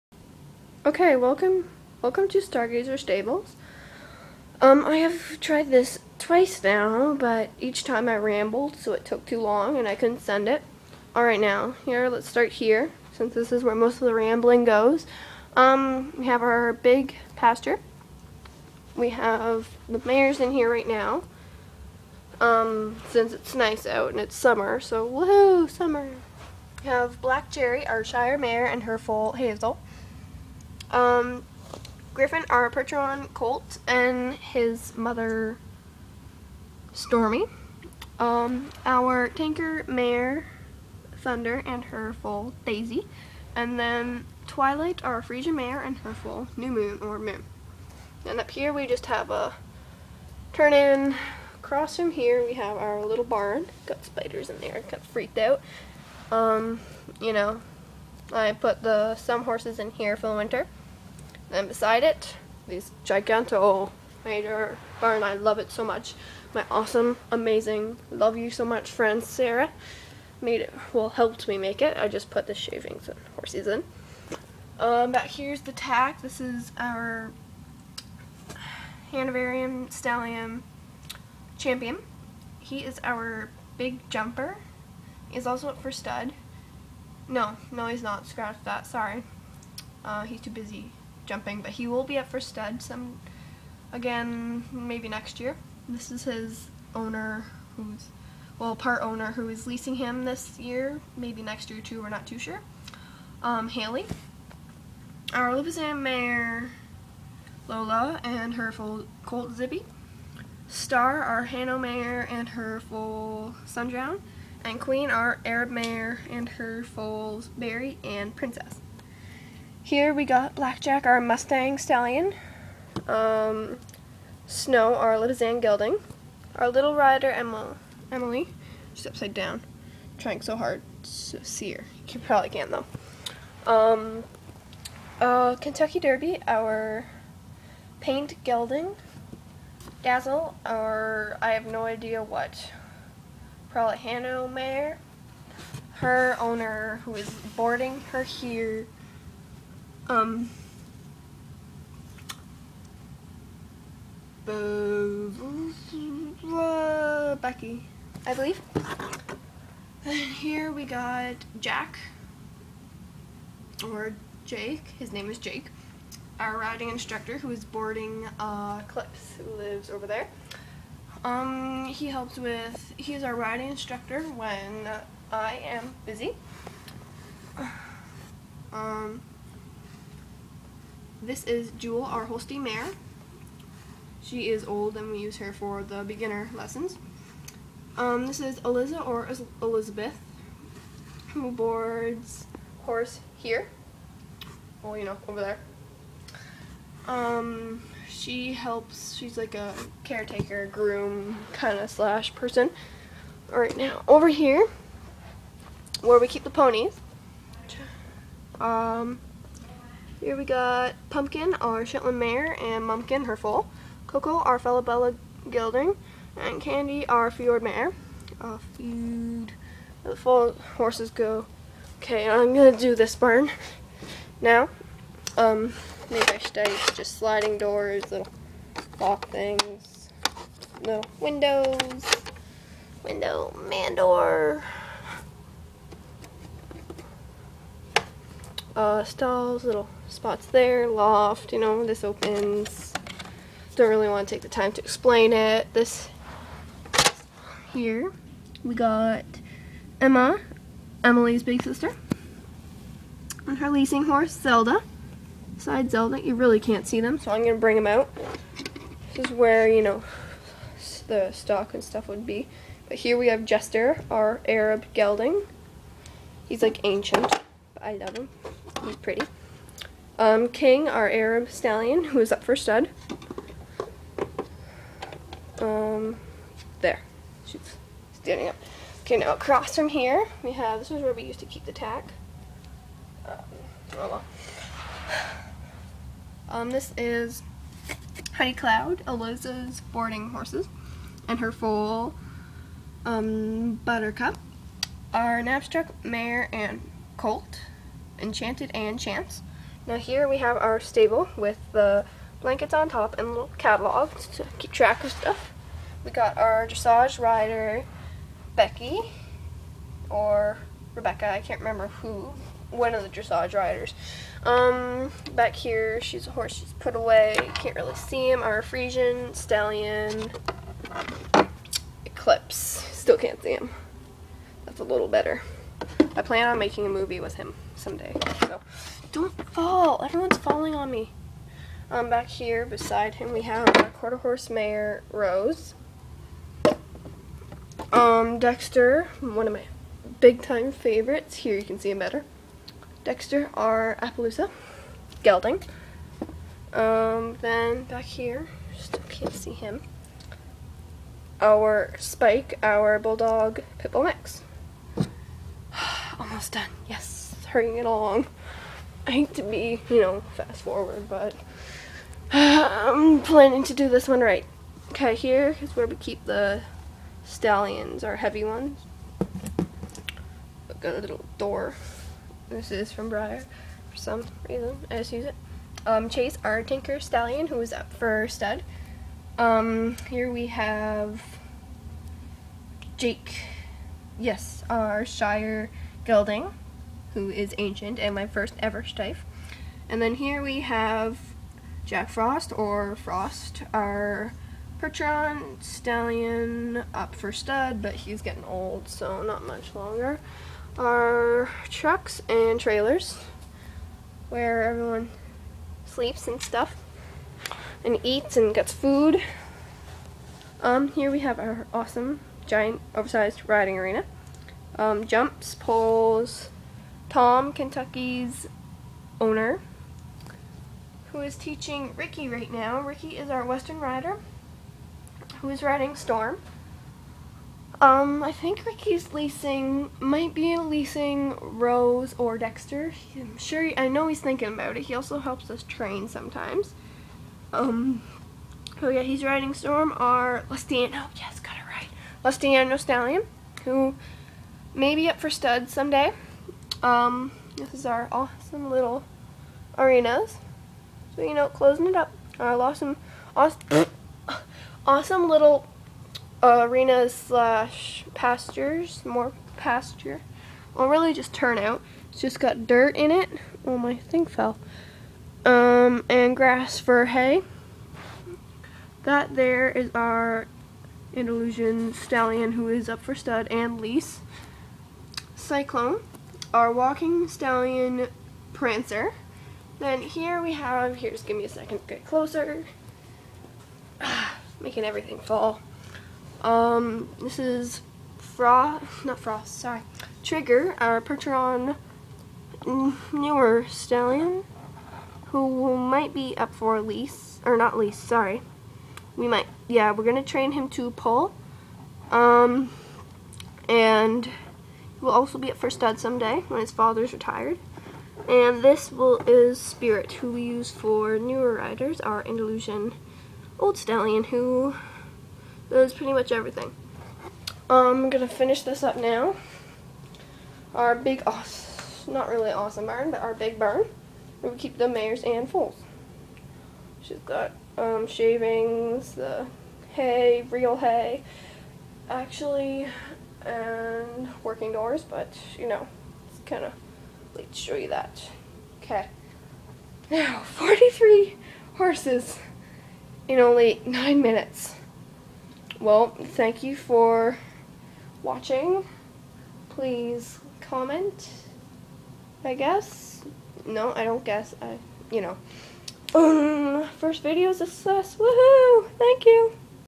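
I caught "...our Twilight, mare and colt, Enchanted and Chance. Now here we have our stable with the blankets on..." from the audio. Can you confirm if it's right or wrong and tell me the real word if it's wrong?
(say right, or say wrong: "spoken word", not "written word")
wrong: "Knabstrup", not "Twilight".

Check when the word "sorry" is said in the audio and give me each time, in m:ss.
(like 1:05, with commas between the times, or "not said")
1:28, 8:09, 8:17.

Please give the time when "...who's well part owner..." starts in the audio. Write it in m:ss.
1:37.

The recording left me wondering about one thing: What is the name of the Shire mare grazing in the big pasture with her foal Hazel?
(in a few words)
Black Jerry.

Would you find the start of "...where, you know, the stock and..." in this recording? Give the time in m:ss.
4:19.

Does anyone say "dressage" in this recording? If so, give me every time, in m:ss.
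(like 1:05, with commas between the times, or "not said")
5:06, 5:13.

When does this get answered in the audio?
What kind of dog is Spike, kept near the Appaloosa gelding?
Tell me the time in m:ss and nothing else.
5:52.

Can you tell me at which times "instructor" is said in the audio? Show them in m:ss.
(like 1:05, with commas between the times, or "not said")
2:46, 2:53.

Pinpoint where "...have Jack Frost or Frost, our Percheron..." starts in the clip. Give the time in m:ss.
6:30.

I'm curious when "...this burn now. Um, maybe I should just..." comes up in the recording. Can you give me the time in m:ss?
3:42.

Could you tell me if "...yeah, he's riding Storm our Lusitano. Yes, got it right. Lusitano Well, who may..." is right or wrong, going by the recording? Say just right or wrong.
wrong.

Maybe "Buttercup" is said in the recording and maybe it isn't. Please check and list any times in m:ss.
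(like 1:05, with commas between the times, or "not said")
4:53.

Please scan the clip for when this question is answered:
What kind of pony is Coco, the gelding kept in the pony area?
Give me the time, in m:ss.
3:34.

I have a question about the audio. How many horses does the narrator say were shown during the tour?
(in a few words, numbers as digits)
43.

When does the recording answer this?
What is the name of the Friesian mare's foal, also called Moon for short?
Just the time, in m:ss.
0:46.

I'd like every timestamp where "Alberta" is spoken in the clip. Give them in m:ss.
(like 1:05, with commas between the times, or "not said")
not said.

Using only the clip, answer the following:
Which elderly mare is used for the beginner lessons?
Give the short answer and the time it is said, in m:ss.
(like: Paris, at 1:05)
Jewel, at 3:01.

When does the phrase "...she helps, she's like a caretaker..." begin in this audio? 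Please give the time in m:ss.
3:18.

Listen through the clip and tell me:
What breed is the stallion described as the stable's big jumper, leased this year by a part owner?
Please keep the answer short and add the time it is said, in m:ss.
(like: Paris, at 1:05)
Hanoverian, at 1:19.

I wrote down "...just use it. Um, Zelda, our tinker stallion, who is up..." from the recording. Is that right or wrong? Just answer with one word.
wrong.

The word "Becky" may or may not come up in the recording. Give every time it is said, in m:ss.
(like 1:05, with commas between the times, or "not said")
2:37, 5:08.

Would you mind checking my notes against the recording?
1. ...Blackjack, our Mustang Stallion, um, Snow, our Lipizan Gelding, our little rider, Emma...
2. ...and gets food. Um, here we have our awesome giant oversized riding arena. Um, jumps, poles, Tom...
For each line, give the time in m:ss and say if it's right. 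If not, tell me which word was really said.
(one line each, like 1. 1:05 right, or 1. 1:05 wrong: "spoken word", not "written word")
1. 2:00 right
2. 6:48 right.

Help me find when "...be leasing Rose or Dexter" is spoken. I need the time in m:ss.
7:10.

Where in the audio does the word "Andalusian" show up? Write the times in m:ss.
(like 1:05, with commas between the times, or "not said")
7:51, 8:32.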